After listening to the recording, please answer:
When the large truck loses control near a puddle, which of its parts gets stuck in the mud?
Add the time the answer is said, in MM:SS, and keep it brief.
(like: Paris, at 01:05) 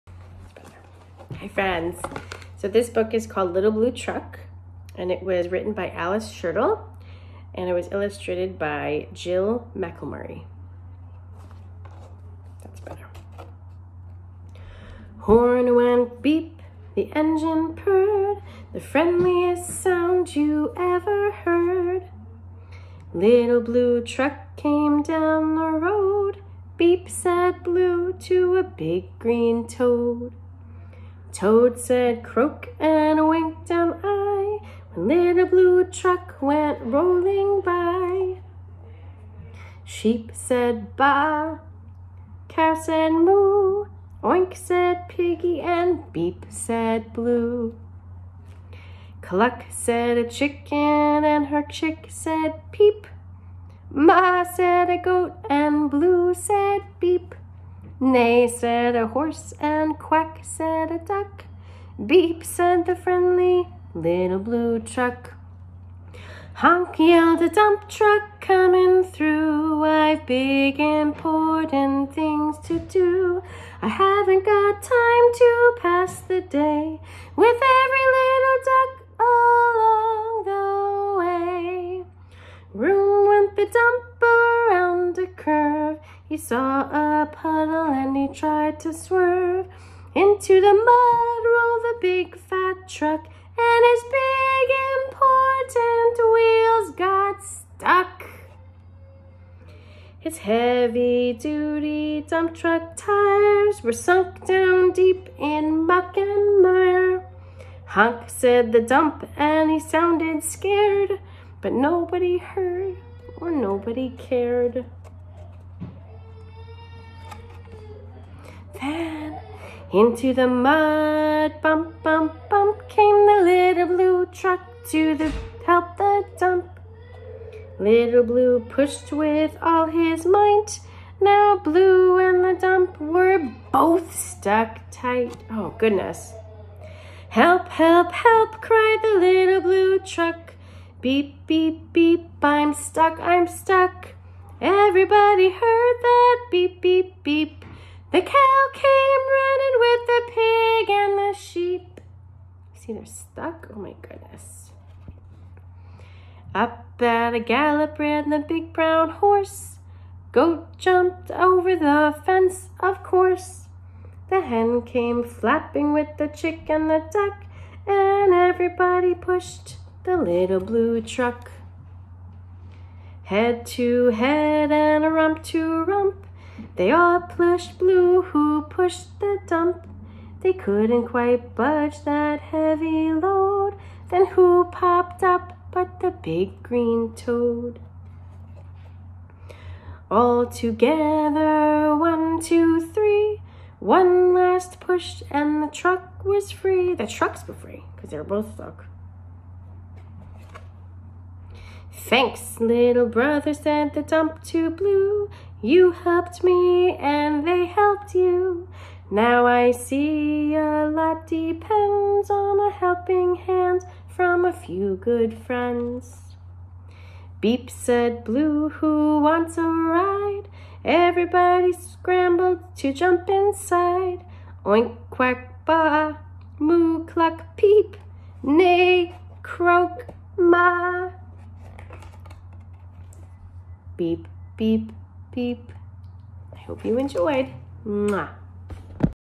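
big important wheels, at 01:34.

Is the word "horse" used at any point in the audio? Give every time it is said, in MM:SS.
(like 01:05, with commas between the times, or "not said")
00:59, 02:39.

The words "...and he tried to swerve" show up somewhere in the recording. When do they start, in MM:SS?
01:27.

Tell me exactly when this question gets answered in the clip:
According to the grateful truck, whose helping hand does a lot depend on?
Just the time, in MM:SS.
03:34.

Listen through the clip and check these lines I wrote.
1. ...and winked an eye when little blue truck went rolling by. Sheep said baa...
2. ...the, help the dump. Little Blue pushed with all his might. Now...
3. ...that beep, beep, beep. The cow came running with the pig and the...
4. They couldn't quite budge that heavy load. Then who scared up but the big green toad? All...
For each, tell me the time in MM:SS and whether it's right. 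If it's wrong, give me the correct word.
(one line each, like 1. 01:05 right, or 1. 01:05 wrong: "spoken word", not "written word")
1. 00:32 right
2. 02:05 right
3. 02:26 right
4. 03:00 wrong: "popped", not "scared".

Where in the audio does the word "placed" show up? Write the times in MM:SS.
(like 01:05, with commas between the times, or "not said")
not said.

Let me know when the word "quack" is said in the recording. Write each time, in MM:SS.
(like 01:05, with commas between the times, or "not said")
00:59, 03:45.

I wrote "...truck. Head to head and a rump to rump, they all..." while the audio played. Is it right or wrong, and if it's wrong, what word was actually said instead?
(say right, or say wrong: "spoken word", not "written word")
right.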